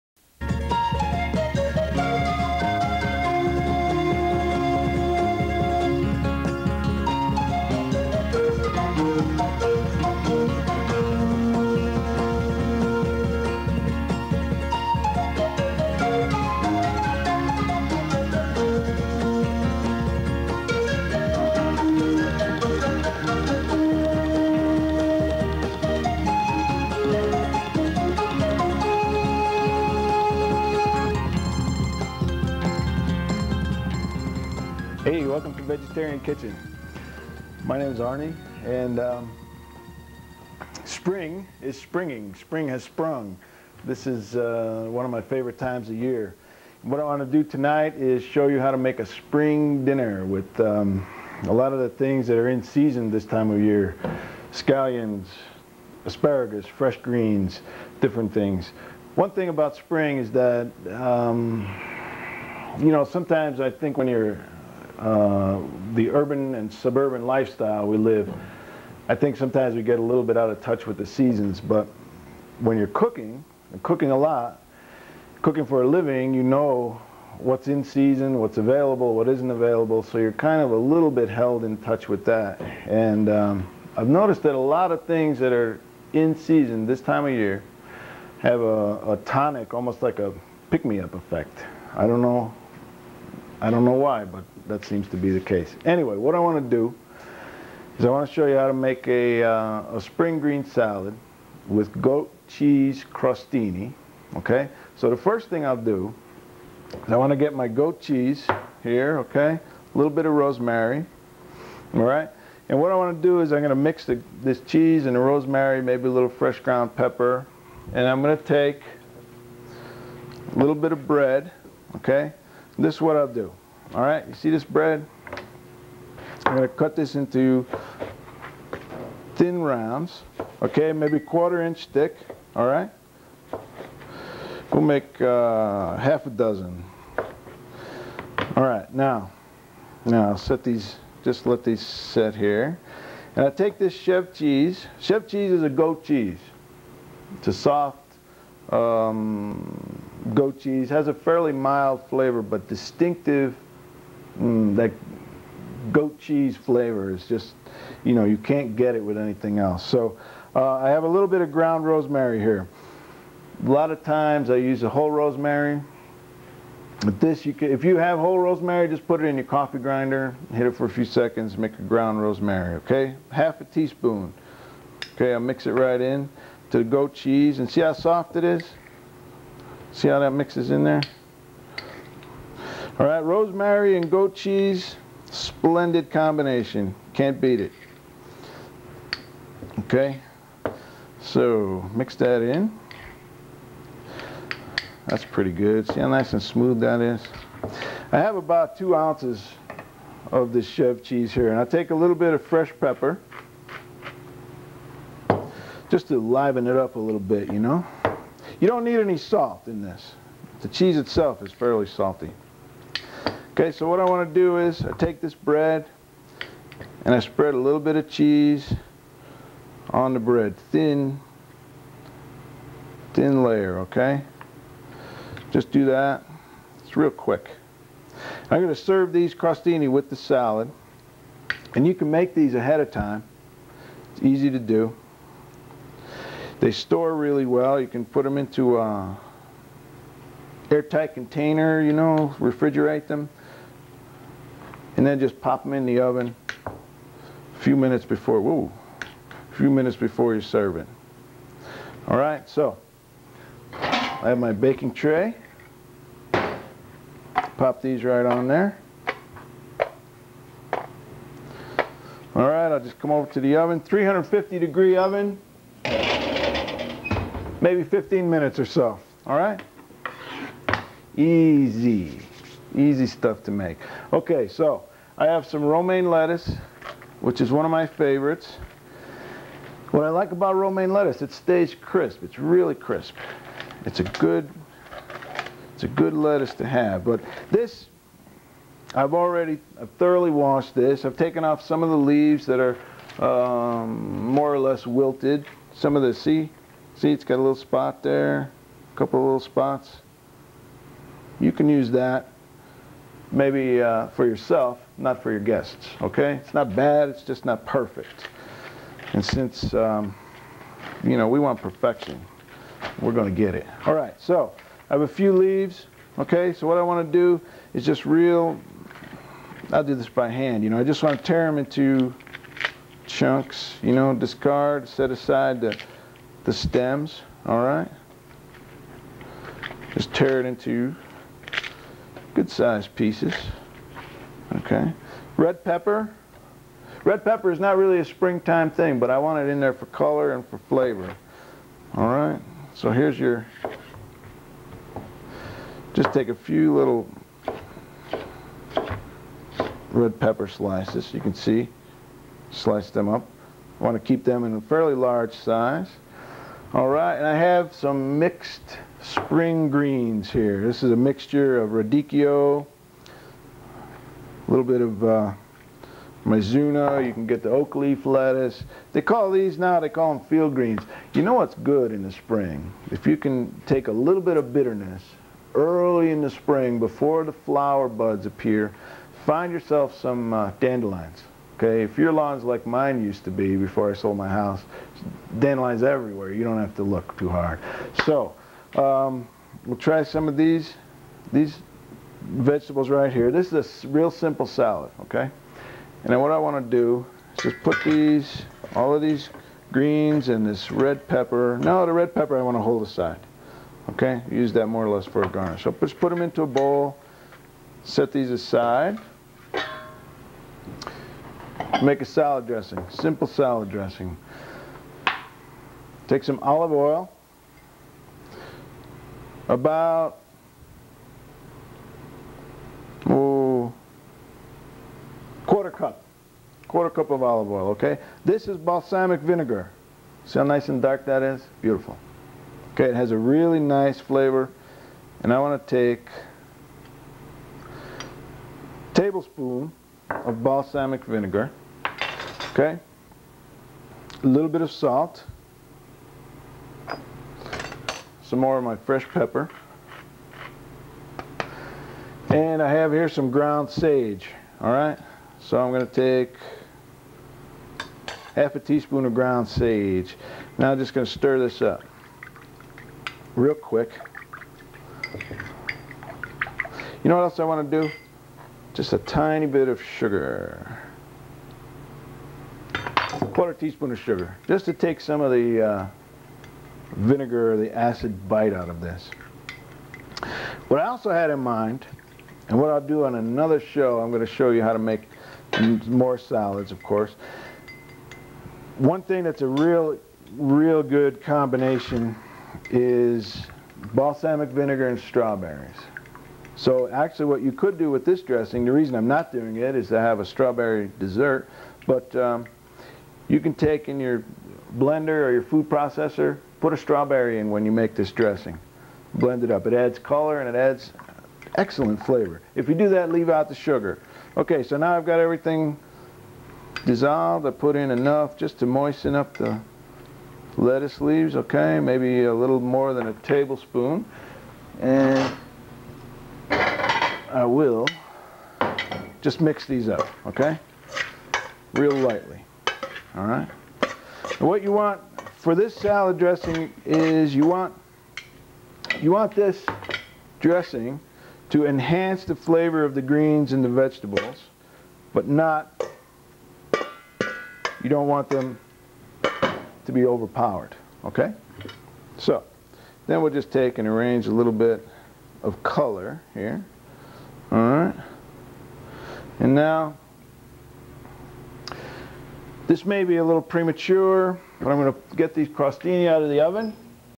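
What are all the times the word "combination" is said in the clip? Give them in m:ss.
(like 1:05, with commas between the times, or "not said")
3:06, 8:11.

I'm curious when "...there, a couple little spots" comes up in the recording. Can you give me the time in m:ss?
4:58.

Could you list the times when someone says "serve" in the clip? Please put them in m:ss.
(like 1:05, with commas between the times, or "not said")
3:48, 4:10.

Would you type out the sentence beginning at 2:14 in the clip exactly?
We'll make uh, half a dozen.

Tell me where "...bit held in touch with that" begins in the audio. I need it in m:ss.
1:21.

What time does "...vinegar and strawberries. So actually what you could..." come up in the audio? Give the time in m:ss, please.
8:14.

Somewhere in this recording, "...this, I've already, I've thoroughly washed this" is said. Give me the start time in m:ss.
4:47.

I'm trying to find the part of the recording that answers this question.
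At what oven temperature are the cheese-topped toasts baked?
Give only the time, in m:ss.
4:23.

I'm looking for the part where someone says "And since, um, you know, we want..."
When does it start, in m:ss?
5:09.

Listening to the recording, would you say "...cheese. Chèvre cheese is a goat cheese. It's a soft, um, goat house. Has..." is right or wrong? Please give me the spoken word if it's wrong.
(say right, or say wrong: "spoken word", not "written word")
wrong: "cheese", not "house".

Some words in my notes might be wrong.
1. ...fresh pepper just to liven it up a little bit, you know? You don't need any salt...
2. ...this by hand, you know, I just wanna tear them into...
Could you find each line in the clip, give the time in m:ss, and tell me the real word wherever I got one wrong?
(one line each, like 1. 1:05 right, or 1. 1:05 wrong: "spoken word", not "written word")
1. 3:22 right
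2. 5:19 right.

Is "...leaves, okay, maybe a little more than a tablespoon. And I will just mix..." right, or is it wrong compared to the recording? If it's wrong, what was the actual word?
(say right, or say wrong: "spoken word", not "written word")
right.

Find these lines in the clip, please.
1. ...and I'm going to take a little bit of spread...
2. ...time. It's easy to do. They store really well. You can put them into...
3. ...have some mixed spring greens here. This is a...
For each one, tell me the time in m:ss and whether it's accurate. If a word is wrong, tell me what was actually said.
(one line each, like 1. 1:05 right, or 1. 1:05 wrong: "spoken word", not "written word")
1. 1:57 wrong: "bread", not "spread"
2. 3:52 right
3. 5:57 right.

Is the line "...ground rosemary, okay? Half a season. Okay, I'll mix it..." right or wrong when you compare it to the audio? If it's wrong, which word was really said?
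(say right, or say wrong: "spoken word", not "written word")
wrong: "teaspoon", not "season".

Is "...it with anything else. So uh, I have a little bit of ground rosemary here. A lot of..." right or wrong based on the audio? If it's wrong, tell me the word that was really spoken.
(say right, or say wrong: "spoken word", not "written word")
right.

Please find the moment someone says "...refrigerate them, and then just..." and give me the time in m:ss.
4:02.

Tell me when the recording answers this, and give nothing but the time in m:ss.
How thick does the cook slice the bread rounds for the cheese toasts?
2:11.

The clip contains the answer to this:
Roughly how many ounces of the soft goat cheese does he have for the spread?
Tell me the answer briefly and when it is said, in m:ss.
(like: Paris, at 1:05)
2, at 3:18.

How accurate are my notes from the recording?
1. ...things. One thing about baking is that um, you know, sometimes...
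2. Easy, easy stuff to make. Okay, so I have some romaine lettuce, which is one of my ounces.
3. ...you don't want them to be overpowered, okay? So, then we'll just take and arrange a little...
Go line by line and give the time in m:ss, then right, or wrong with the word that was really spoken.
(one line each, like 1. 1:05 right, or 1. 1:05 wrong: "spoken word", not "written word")
1. 0:58 wrong: "spring", not "baking"
2. 4:31 wrong: "favorites", not "ounces"
3. 9:07 right.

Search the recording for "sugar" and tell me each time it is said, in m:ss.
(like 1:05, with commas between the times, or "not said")
7:49, 7:53, 8:33.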